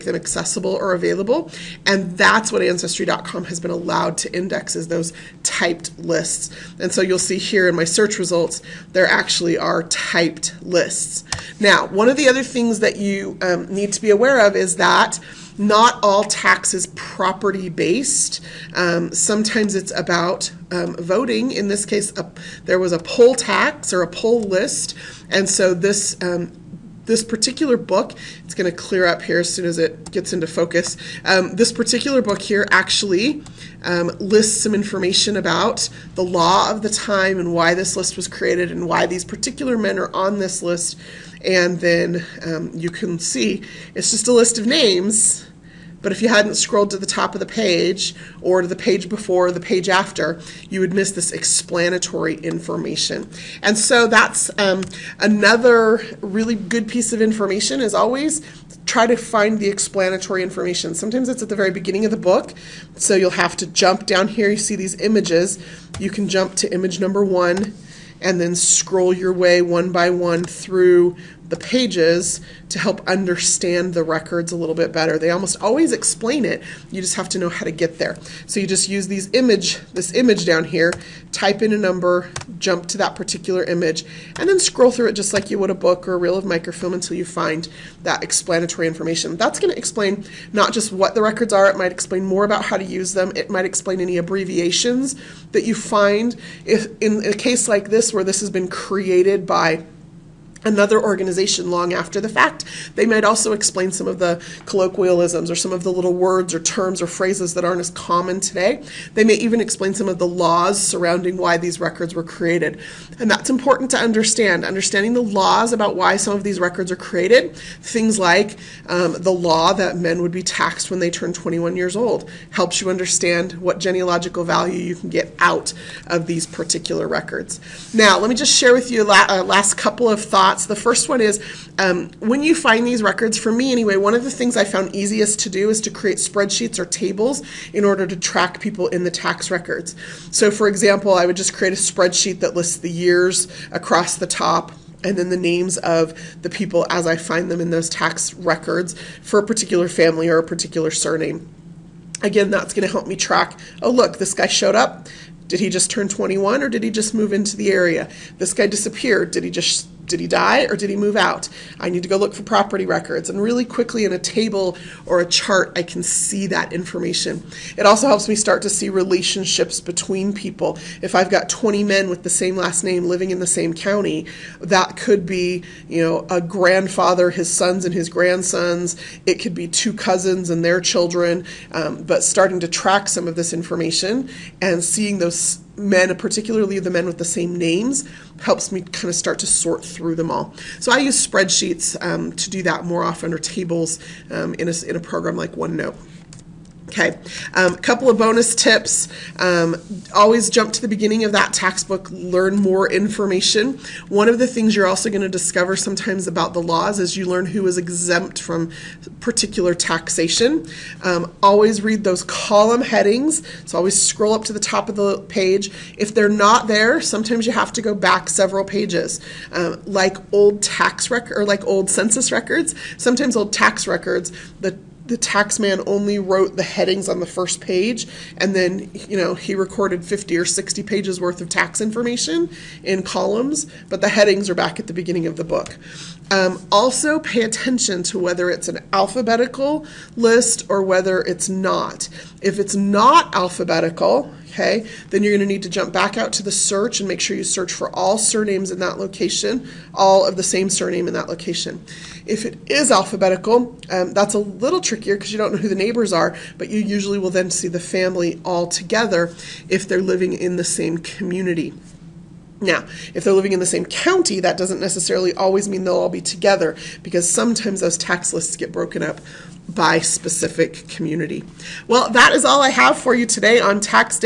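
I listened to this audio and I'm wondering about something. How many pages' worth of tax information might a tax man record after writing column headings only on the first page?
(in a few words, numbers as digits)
50 or 60.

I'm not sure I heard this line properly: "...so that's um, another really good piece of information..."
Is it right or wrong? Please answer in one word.
right.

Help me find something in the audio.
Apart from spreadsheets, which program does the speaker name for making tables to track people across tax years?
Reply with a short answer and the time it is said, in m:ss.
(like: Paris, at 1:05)
OneNote, at 3:15.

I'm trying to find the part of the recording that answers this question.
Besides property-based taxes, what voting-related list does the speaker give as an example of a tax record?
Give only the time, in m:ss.
0:24.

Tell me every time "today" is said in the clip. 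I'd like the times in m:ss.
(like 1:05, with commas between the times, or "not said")
1:48, 4:33.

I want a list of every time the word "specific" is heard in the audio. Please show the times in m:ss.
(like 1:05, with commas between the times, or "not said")
4:29.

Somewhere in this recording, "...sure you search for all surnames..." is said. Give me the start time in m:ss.
4:07.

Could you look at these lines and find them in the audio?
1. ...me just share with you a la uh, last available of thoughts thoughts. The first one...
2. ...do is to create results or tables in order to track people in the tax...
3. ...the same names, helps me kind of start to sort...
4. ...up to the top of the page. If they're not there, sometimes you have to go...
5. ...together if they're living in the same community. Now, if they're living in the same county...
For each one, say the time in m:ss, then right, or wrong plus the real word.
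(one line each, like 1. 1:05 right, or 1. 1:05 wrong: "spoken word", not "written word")
1. 2:08 wrong: "couple", not "available"
2. 2:15 wrong: "spreadsheets", not "results"
3. 3:07 right
4. 3:34 right
5. 4:18 right.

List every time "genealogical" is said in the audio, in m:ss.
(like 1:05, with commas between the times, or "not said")
2:03.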